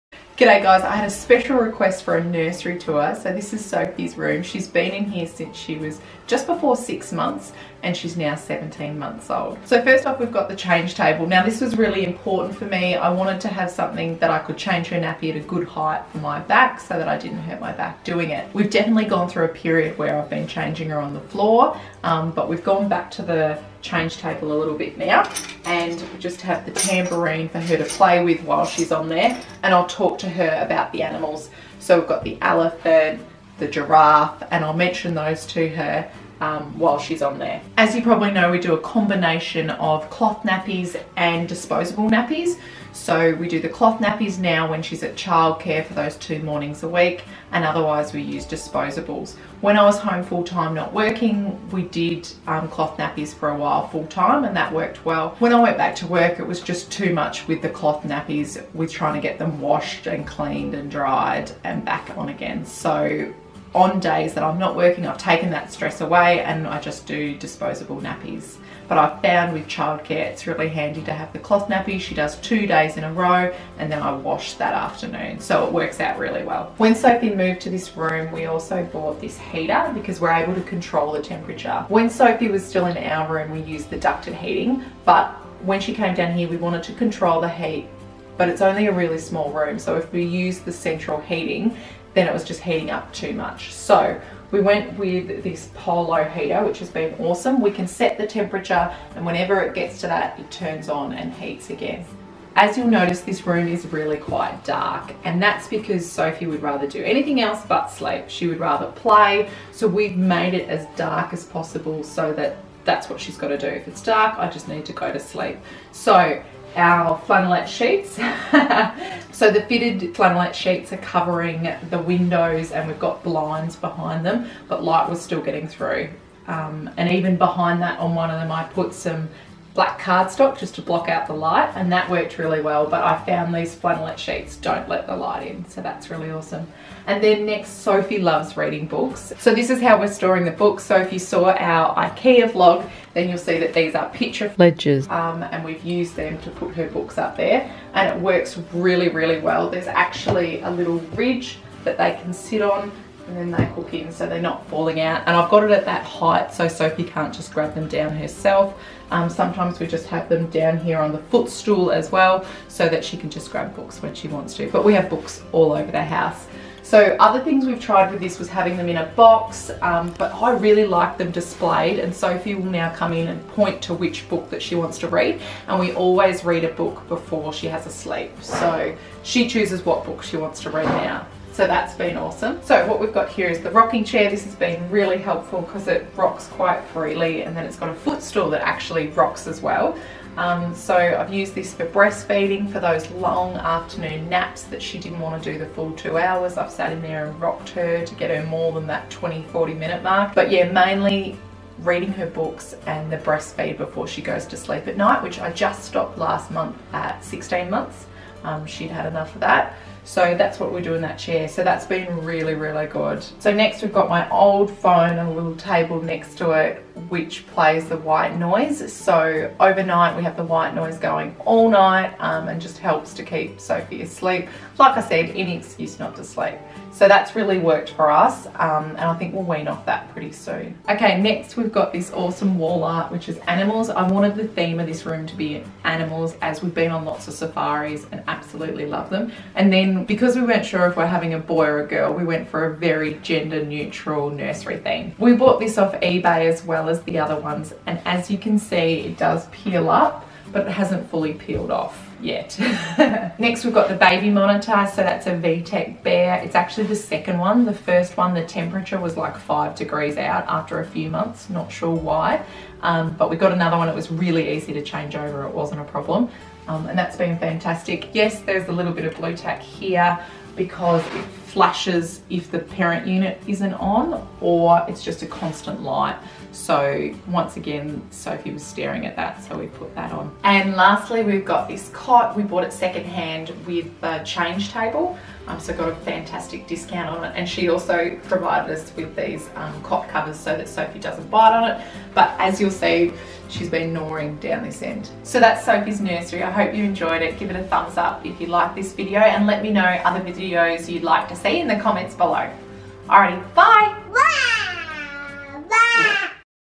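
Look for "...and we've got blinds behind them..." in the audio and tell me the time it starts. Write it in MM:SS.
02:02.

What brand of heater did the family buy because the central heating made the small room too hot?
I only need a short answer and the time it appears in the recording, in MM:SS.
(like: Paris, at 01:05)
Polo, at 01:35.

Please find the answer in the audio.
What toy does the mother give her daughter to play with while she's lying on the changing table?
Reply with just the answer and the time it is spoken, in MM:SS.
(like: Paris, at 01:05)
Tambourine, at 00:26.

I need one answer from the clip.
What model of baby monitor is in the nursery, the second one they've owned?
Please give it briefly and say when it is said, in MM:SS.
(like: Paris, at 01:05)
VTech Bear, at 04:15.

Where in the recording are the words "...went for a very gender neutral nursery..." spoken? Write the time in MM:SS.
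04:02.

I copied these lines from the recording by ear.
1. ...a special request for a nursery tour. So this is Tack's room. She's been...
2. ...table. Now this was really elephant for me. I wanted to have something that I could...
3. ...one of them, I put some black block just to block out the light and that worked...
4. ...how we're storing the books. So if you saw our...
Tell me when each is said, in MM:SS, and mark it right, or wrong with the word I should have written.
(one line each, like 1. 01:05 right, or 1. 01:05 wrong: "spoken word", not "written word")
1. 00:01 wrong: "Sophie", not "Tack"
2. 00:10 wrong: "important", not "elephant"
3. 02:08 wrong: "cardstock", not "block"
4. 02:19 right.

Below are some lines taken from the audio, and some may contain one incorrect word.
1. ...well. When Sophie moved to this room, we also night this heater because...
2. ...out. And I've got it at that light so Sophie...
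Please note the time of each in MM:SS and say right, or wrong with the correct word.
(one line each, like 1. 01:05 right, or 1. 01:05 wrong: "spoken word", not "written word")
1. 01:16 wrong: "bought", not "night"
2. 02:35 wrong: "height", not "light".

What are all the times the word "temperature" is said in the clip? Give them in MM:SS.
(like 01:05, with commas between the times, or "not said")
01:21, 01:38, 04:18.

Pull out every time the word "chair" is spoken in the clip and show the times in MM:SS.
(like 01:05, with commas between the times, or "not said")
03:04, 03:31.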